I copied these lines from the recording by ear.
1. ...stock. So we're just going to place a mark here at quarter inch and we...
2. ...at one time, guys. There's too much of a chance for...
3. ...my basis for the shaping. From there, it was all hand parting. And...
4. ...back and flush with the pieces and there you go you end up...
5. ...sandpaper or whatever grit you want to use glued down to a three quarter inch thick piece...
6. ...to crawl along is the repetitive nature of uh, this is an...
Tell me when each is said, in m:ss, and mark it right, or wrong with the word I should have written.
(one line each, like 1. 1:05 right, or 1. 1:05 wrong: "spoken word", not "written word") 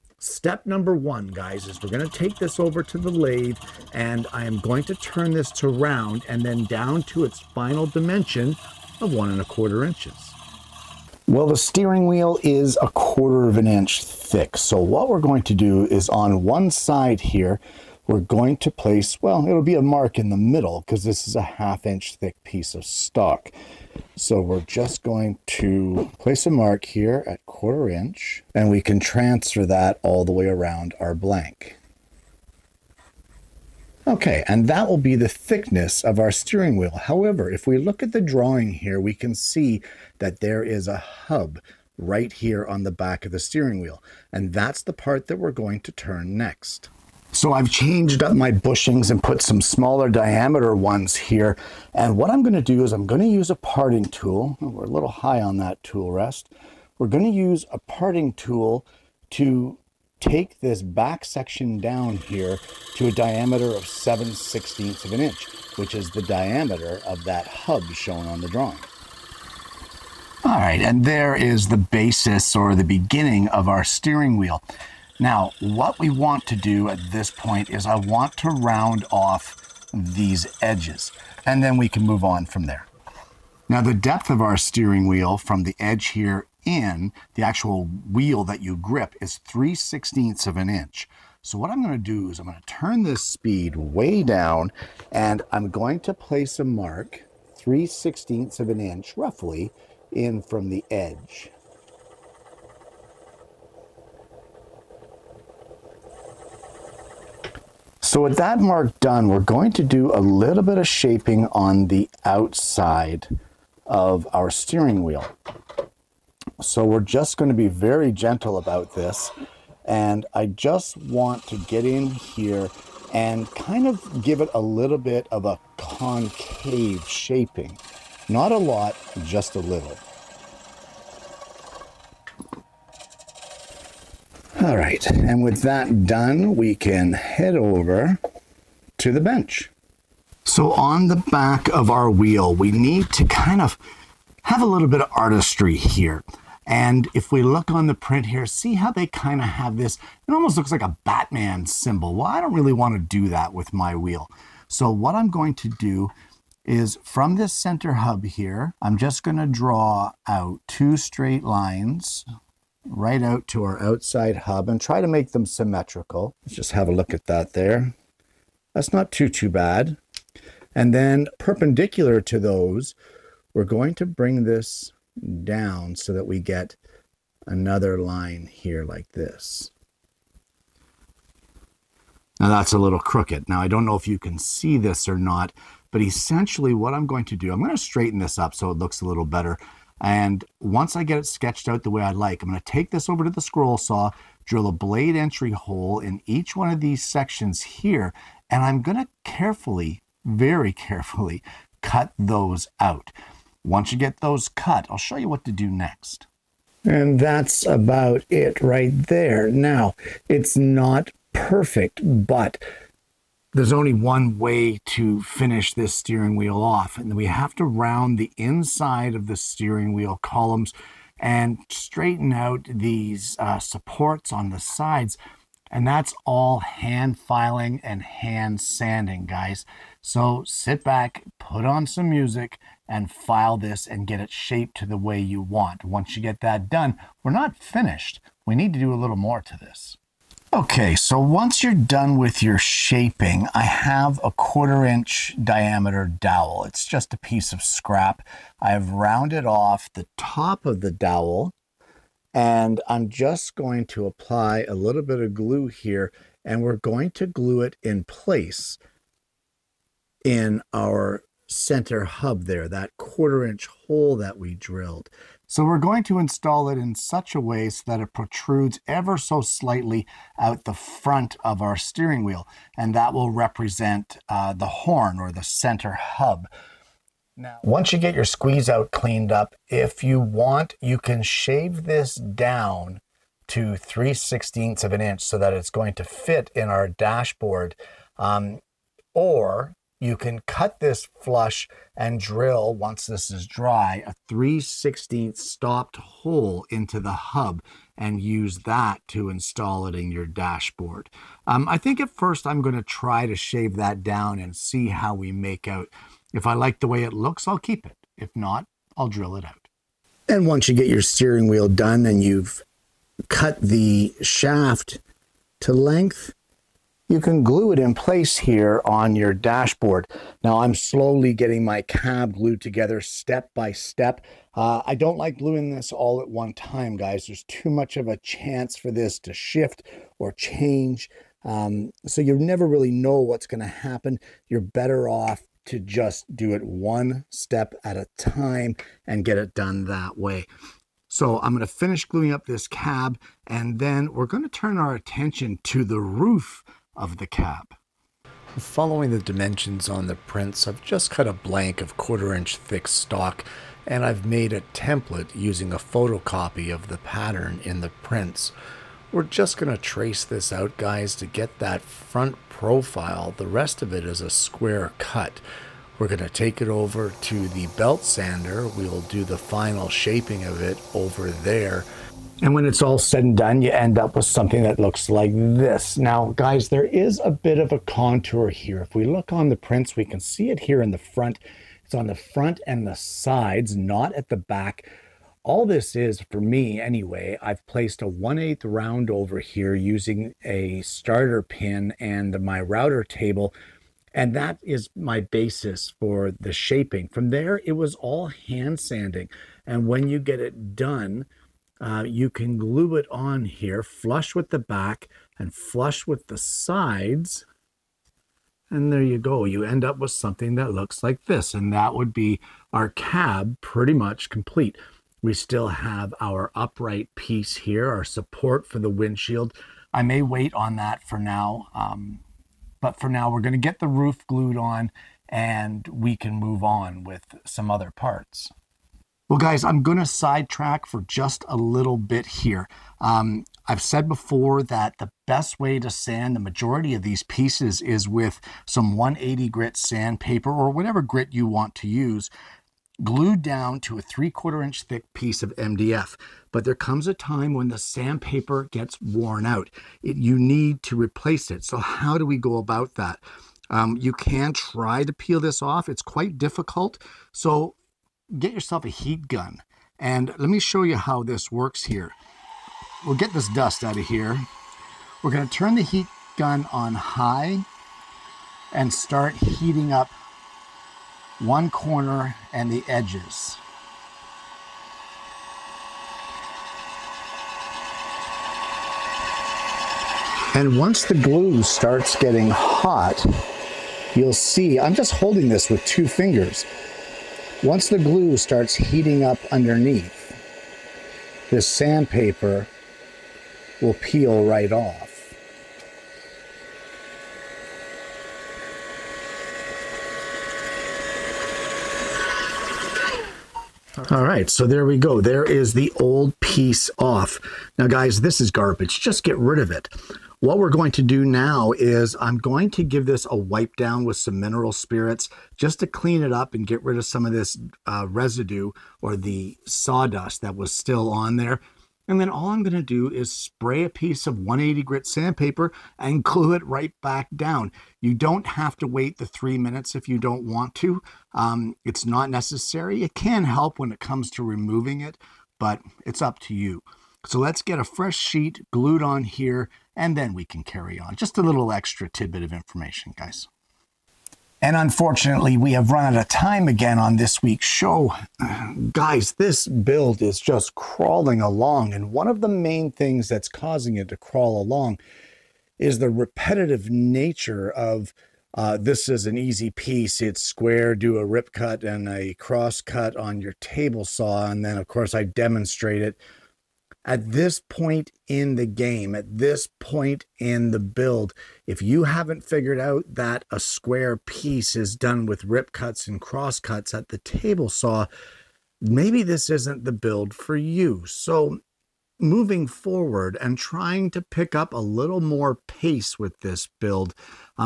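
1. 0:22 right
2. 5:26 right
3. 6:34 wrong: "sanding", not "parting"
4. 6:44 wrong: "sides", not "pieces"
5. 7:19 right
6. 9:14 right.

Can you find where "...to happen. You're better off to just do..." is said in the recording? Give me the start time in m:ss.
5:33.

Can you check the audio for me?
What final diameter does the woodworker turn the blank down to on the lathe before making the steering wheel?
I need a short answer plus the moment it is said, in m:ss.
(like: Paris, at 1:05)
1 1/4 inches, at 0:09.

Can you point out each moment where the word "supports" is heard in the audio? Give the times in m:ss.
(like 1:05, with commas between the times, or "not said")
3:43, 6:58.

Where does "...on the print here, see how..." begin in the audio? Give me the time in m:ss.
2:27.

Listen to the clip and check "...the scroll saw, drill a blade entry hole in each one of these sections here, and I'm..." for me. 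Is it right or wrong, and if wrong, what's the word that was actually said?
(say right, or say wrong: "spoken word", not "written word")
right.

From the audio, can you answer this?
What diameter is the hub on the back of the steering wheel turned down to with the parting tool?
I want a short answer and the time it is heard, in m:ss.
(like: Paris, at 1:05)
7/16 inch, at 1:03.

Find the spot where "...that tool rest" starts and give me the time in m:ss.
0:55.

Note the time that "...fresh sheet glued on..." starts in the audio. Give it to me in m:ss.
8:57.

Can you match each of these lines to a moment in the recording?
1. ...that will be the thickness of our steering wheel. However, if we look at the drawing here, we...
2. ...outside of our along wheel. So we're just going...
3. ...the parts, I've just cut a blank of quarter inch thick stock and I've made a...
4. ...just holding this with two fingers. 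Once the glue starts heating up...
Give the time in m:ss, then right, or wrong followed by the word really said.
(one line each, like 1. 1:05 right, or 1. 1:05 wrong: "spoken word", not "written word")
1. 0:34 right
2. 1:52 wrong: "steering", not "along"
3. 5:50 wrong: "prints", not "parts"
4. 8:04 right.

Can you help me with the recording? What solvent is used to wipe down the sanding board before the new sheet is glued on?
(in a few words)
mineral spirits.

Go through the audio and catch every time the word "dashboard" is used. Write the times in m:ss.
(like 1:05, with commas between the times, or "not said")
4:46, 5:00, 5:19.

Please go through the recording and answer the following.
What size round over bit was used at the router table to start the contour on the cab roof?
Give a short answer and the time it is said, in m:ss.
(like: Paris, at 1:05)
1/8 inch, at 6:28.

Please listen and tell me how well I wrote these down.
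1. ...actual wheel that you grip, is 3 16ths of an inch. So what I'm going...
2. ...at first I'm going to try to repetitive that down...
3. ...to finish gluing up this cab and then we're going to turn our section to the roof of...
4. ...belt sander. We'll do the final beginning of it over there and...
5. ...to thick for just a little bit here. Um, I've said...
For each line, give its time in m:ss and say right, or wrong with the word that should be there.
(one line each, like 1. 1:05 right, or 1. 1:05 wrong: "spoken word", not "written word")
1. 1:27 right
2. 5:01 wrong: "shave", not "repetitive"
3. 5:41 wrong: "attention", not "section"
4. 6:07 wrong: "shaping", not "beginning"
5. 7:09 wrong: "sidetrack", not "thick".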